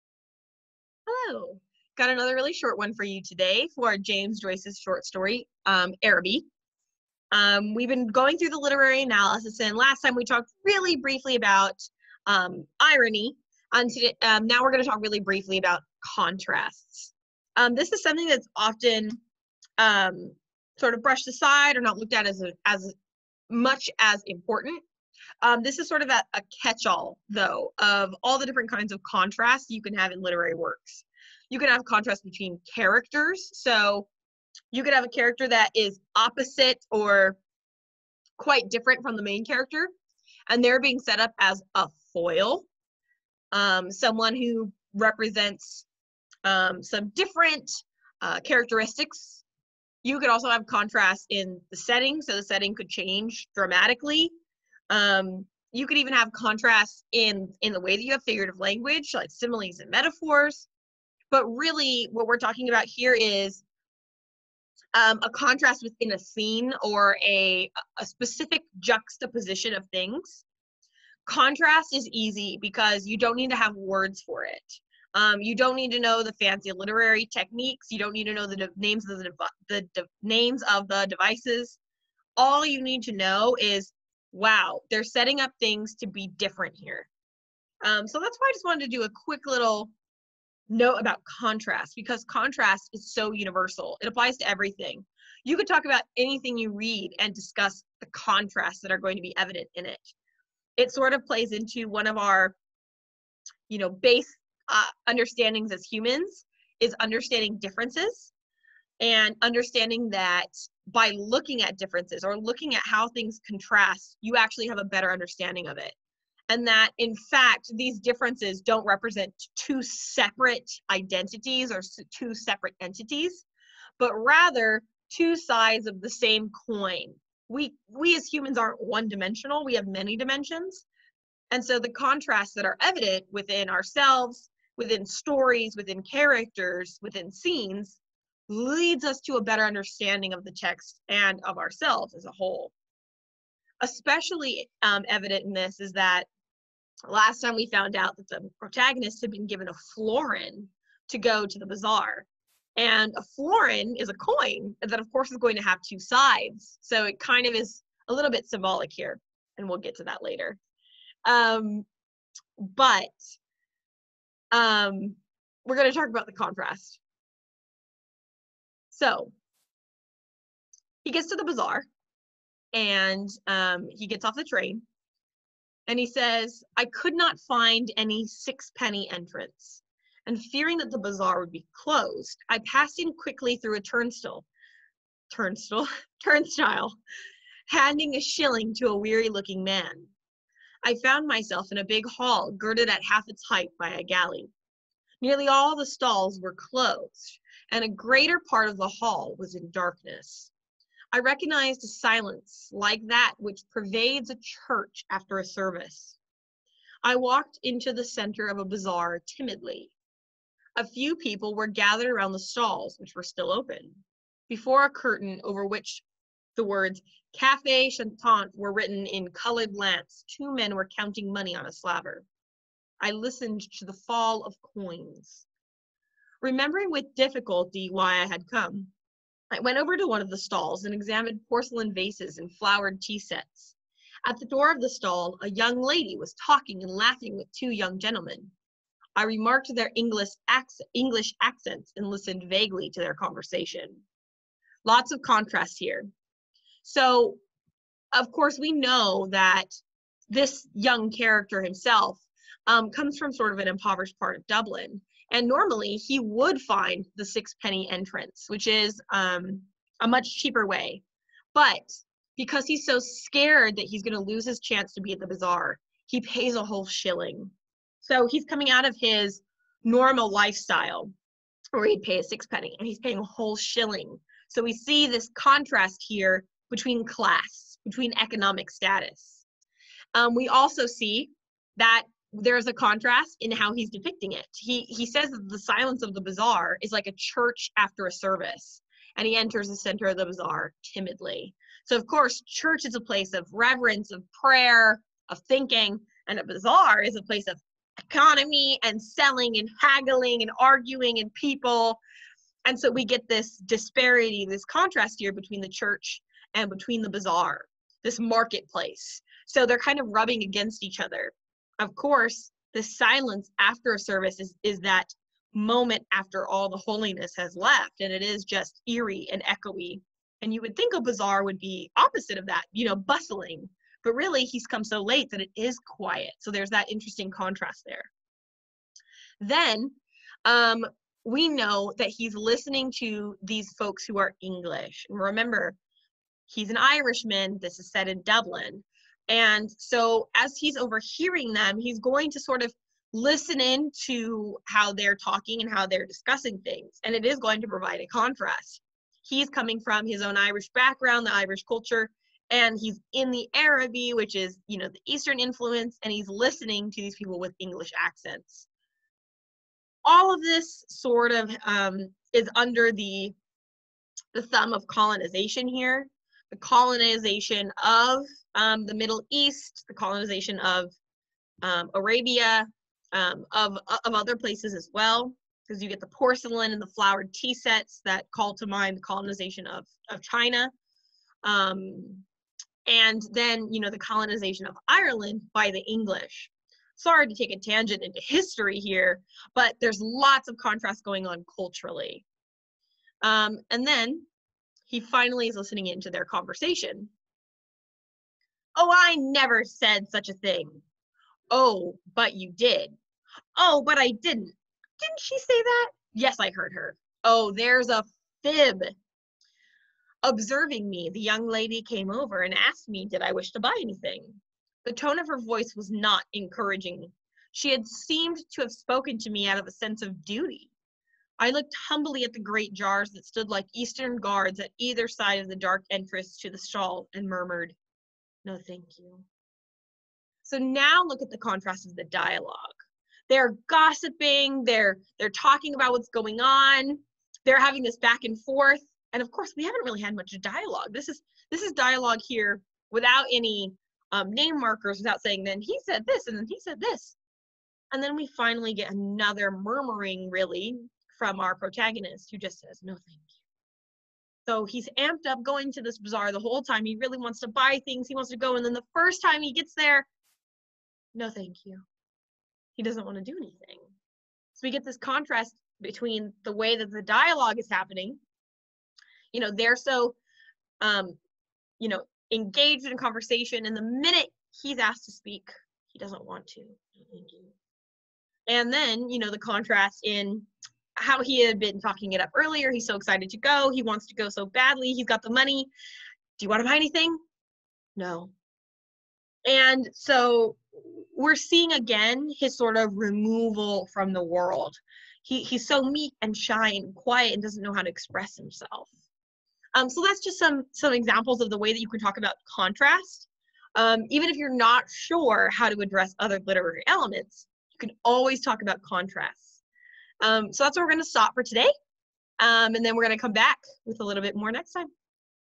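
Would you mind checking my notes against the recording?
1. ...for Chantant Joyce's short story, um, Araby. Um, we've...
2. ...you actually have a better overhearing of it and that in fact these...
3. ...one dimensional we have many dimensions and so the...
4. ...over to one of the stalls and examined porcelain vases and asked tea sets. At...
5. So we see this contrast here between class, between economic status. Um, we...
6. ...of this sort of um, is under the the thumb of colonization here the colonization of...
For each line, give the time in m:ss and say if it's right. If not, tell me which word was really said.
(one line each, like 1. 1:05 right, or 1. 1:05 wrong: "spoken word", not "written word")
1. 0:03 wrong: "James", not "Chantant"
2. 1:54 wrong: "understanding", not "overhearing"
3. 2:08 right
4. 3:49 wrong: "flowered", not "asked"
5. 4:34 right
6. 6:00 right.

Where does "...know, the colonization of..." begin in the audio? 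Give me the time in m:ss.
6:23.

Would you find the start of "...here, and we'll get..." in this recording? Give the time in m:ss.
2:38.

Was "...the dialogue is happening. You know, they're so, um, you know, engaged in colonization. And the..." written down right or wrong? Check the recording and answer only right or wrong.
wrong.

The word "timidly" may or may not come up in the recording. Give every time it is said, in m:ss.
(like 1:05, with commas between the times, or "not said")
3:29, 4:50.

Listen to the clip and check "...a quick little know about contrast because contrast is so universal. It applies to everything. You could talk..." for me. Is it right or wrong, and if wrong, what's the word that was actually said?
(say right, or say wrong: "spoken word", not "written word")
right.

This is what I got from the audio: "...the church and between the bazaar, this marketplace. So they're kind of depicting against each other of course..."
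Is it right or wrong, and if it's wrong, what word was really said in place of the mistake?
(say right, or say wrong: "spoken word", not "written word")
wrong: "rubbing", not "depicting".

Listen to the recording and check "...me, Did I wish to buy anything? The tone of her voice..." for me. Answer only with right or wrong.
right.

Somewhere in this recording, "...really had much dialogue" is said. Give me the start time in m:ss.
7:19.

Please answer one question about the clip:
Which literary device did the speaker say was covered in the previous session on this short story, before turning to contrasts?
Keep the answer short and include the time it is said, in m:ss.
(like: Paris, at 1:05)
Irony, at 0:12.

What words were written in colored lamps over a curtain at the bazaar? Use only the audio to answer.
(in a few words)
Cafe Chantant.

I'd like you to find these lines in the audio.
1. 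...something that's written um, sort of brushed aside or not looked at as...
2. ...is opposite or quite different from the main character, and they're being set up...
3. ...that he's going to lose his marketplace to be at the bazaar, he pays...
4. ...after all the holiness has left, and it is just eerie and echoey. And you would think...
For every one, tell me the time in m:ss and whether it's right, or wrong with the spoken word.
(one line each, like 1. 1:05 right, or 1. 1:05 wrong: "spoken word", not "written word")
1. 0:18 wrong: "often", not "written"
2. 0:35 right
3. 4:23 wrong: "chance", not "marketplace"
4. 5:16 right.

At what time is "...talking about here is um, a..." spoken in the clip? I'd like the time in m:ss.
1:02.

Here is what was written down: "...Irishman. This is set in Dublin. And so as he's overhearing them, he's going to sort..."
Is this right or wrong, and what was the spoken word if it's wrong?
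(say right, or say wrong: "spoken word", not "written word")
right.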